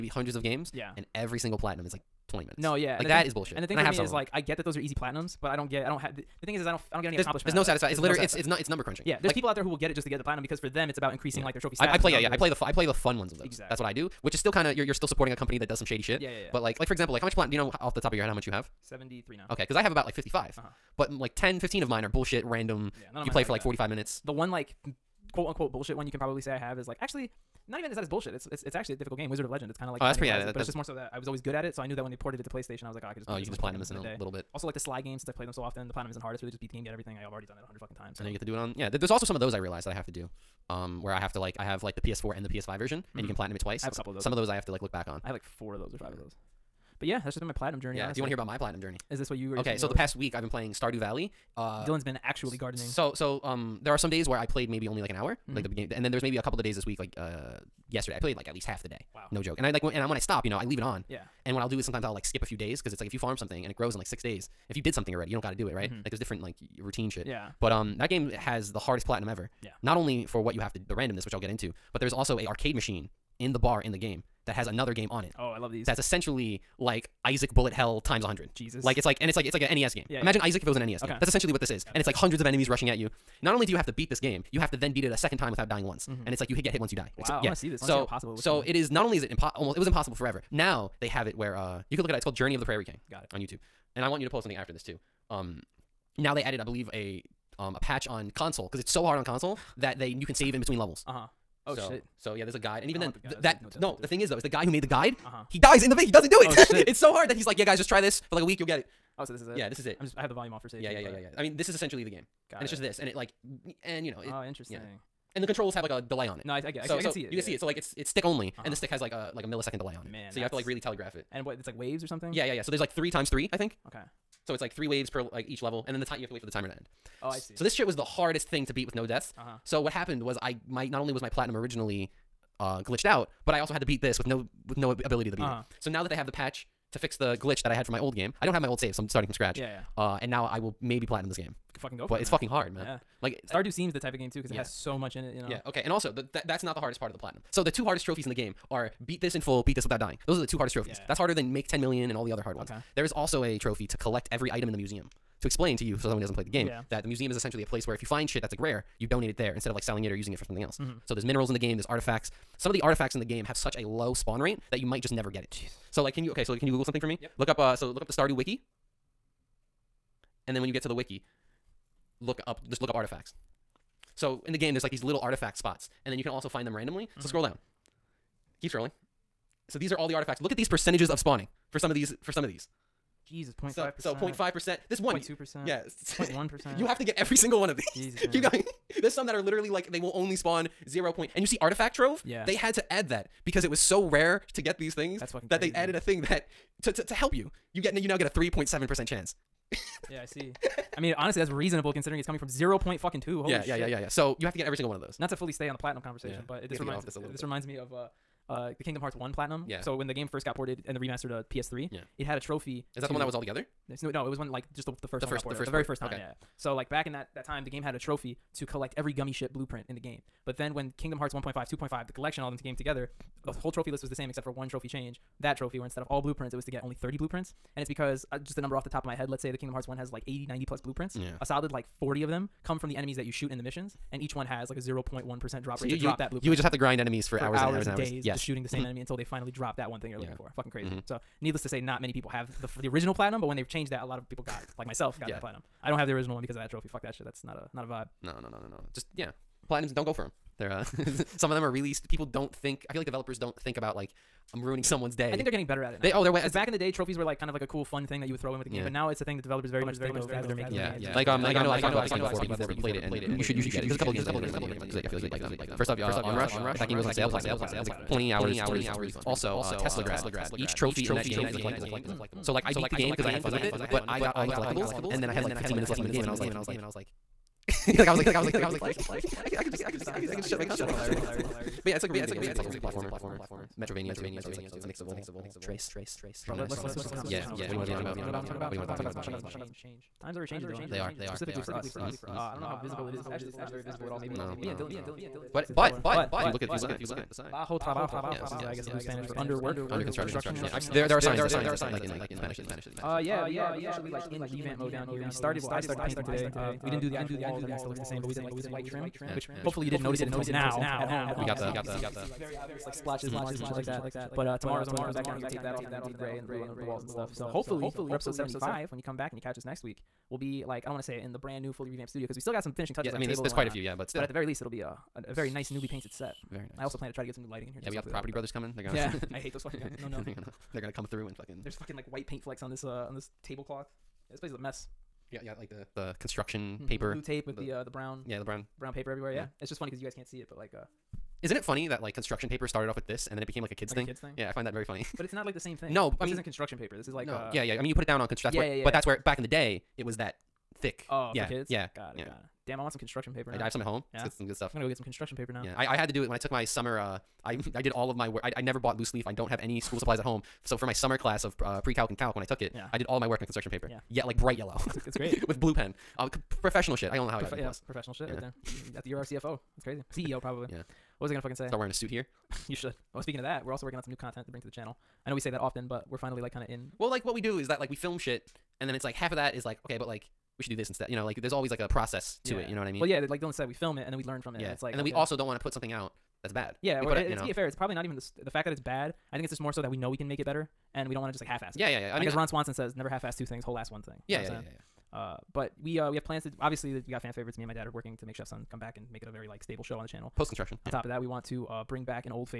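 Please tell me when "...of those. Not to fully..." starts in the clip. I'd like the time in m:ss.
3:24.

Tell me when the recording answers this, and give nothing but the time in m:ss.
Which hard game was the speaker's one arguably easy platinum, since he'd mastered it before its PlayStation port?
0:29.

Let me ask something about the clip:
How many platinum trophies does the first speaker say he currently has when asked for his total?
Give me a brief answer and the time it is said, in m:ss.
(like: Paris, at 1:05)
73, at 0:18.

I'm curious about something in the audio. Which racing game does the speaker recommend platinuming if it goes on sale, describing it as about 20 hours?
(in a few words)
Onrush.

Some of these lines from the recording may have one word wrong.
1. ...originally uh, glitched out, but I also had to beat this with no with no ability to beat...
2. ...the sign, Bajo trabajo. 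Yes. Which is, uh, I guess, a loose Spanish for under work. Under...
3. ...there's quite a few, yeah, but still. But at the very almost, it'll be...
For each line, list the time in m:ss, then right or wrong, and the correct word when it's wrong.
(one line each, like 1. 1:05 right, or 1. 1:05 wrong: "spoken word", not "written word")
1. 2:11 right
2. 4:56 right
3. 5:23 wrong: "least", not "almost".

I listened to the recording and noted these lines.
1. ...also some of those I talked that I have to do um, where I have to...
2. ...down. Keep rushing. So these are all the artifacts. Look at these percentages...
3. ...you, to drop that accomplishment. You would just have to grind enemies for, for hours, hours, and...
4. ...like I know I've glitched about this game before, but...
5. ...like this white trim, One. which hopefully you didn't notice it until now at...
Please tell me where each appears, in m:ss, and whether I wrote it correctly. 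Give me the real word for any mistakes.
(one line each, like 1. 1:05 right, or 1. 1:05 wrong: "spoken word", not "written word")
1. 0:39 wrong: "realized", not "talked"
2. 2:57 wrong: "scrolling", not "rushing"
3. 3:55 wrong: "blueprint", not "accomplishment"
4. 4:21 wrong: "talked", not "glitched"
5. 5:08 wrong: "Yeah", not "One".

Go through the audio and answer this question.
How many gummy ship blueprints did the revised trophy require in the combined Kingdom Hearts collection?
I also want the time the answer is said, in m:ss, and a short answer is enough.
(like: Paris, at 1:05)
30, at 3:46.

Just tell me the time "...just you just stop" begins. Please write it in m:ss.
4:39.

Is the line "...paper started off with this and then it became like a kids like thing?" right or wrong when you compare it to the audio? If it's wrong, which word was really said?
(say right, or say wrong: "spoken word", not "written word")
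right.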